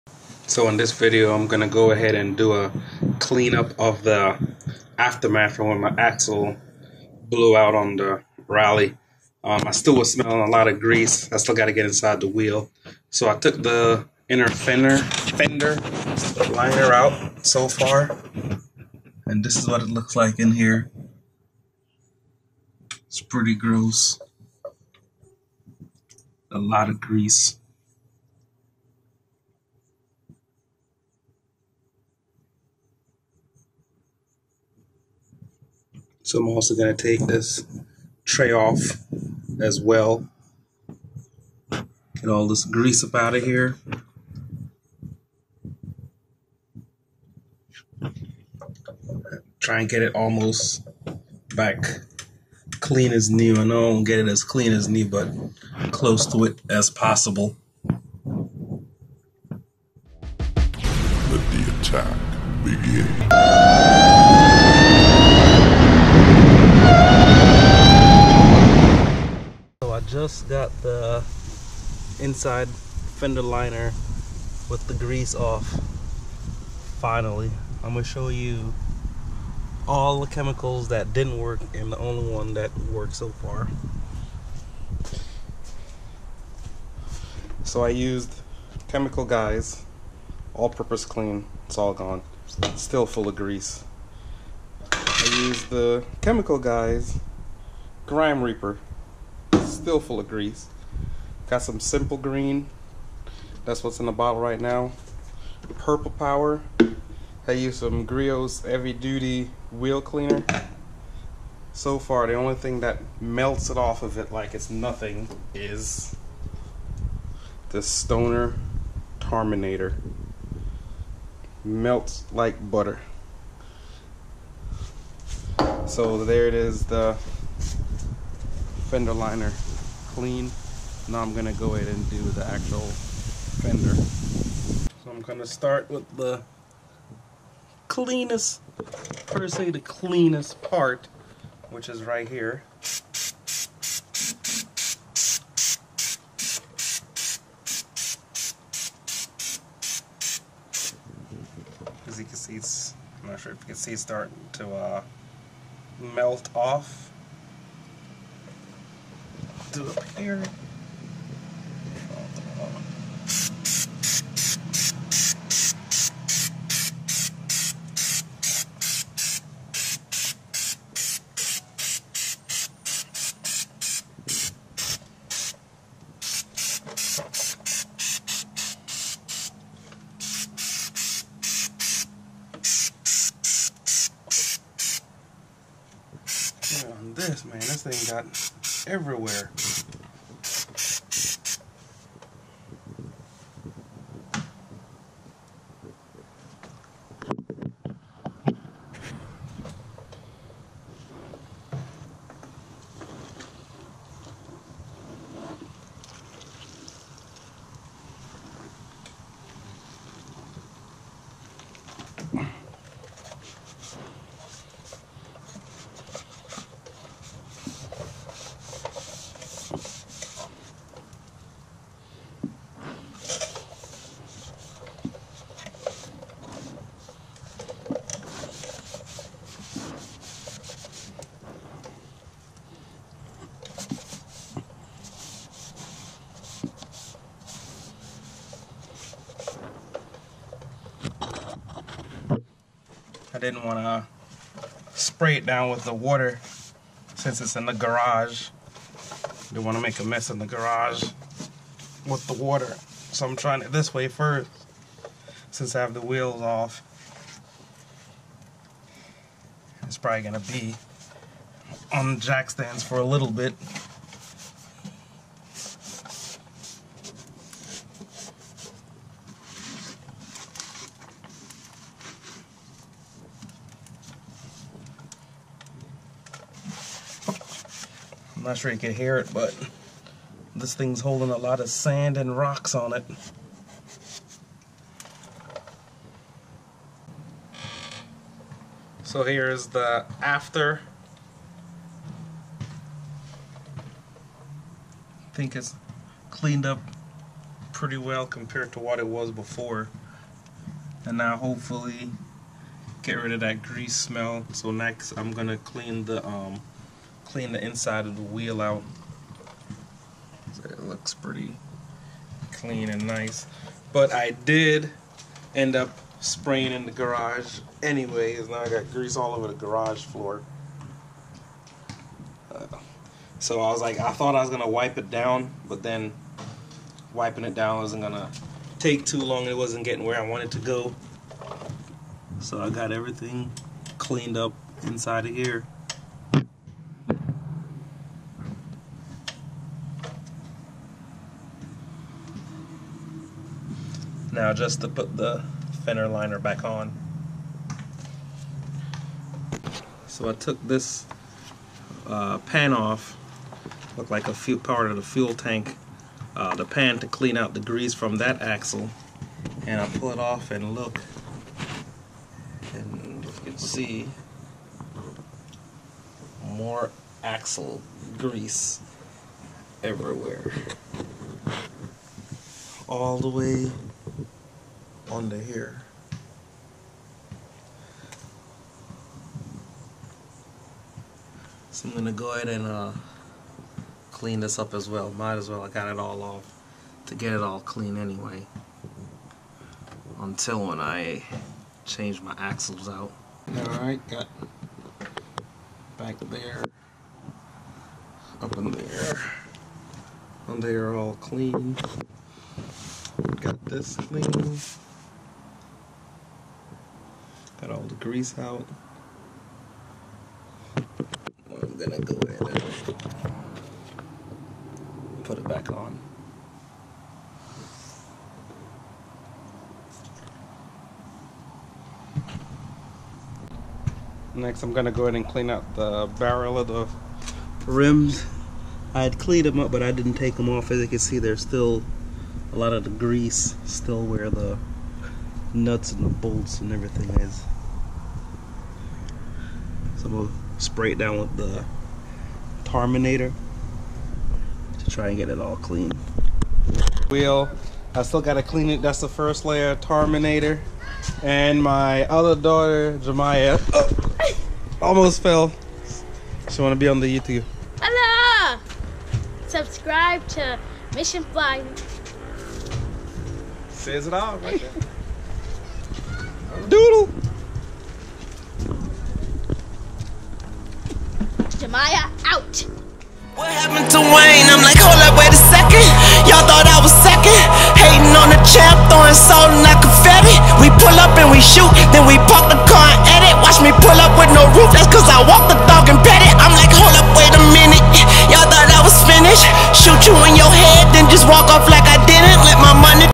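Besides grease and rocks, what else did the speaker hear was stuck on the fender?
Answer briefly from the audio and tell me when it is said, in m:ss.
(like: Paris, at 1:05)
sand, at 4:41.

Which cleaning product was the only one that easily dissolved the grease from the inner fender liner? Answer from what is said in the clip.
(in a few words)
Stoner Terminator.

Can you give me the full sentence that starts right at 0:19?
And this is what it looks like in here.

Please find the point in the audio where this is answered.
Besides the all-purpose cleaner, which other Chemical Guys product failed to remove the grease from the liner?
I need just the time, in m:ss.
1:38.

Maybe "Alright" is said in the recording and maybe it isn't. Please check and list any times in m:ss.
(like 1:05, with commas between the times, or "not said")
6:33.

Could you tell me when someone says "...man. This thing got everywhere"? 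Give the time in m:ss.
3:07.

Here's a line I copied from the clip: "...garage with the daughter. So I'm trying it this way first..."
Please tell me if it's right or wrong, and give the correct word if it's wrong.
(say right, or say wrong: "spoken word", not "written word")
wrong: "water", not "daughter".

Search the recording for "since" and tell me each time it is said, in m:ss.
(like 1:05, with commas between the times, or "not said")
4:07, 4:15.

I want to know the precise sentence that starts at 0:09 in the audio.
Um, I still was smelling a lot of grease.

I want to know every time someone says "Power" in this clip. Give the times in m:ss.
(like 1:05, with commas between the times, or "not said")
1:46.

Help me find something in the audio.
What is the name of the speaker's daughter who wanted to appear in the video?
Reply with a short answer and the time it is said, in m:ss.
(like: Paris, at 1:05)
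Jemaya, at 7:33.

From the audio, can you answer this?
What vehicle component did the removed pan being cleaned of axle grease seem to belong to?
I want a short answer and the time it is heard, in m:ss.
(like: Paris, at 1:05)
fuel tank, at 5:55.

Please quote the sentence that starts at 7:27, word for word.
Wheel, I still gotta clean it.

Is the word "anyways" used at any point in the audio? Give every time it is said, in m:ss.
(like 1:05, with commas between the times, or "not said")
5:17, 6:27.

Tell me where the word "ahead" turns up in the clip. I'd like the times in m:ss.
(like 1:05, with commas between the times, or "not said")
0:01, 2:11, 6:22, 6:52, 7:05.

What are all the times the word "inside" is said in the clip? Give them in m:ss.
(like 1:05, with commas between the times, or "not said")
0:11, 1:12, 5:07, 5:34.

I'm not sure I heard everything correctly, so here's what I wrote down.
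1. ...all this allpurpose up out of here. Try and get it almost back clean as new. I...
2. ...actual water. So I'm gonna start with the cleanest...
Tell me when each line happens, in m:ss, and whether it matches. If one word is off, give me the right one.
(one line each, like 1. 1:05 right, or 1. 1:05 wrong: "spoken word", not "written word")
1. 0:42 wrong: "grease", not "allpurpose"
2. 2:12 wrong: "fender", not "water".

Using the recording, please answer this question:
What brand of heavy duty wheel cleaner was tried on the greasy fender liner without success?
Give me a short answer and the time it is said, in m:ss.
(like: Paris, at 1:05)
Griot's, at 1:48.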